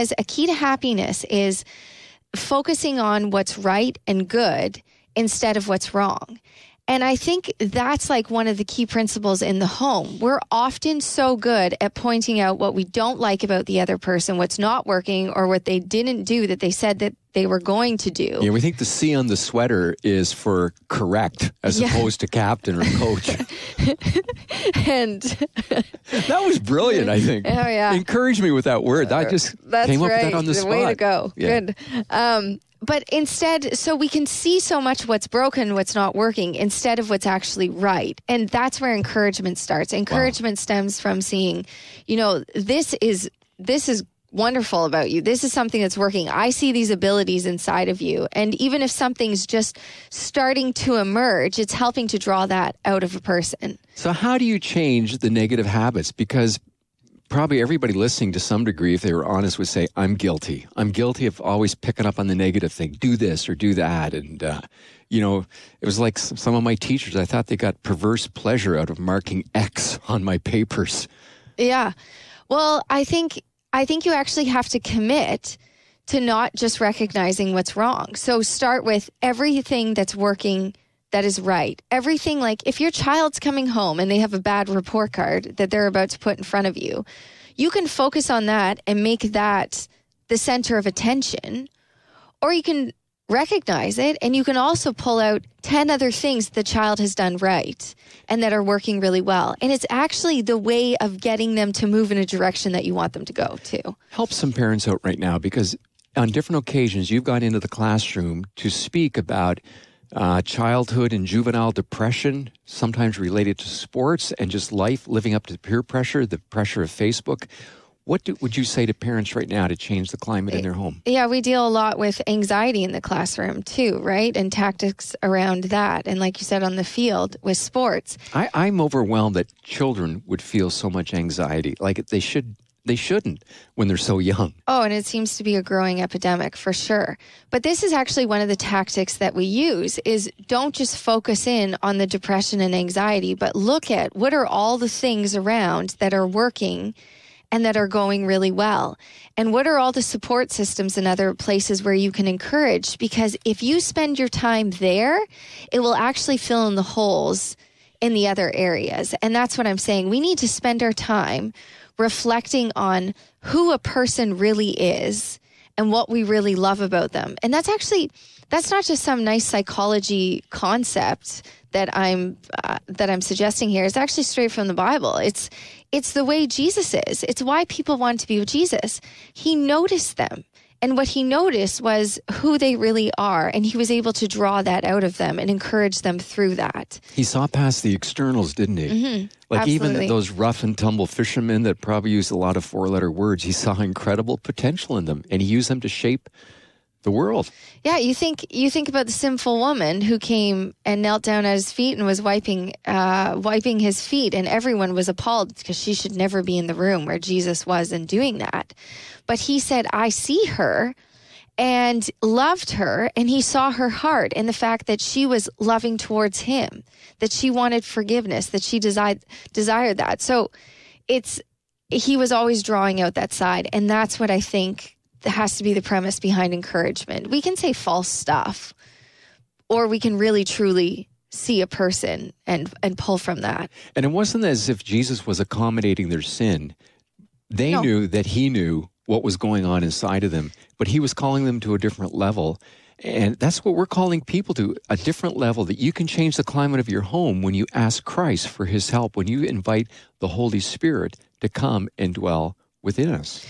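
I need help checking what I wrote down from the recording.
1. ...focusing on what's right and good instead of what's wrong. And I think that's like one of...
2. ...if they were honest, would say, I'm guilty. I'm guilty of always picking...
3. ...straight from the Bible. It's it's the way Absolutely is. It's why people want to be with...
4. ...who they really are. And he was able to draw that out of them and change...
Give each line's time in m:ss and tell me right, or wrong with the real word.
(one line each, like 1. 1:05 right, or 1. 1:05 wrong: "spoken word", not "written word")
1. 0:02 right
2. 0:58 right
3. 2:54 wrong: "Jesus", not "Absolutely"
4. 3:02 wrong: "encourage", not "change".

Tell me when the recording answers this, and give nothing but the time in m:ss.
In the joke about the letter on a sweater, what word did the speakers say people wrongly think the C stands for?
0:20.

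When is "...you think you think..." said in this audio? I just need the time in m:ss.
3:17.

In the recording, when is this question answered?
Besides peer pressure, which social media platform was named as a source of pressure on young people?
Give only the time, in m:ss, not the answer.
1:56.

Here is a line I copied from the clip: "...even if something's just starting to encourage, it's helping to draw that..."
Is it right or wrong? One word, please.
wrong.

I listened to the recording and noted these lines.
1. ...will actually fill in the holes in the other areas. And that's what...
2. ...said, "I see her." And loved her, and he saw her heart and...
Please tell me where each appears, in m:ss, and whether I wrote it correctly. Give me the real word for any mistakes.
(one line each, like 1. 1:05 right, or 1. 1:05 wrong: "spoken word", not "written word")
1. 2:35 right
2. 3:29 right.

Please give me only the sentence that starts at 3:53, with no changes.
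And it wasn't as if Jesus was accommodating their sin.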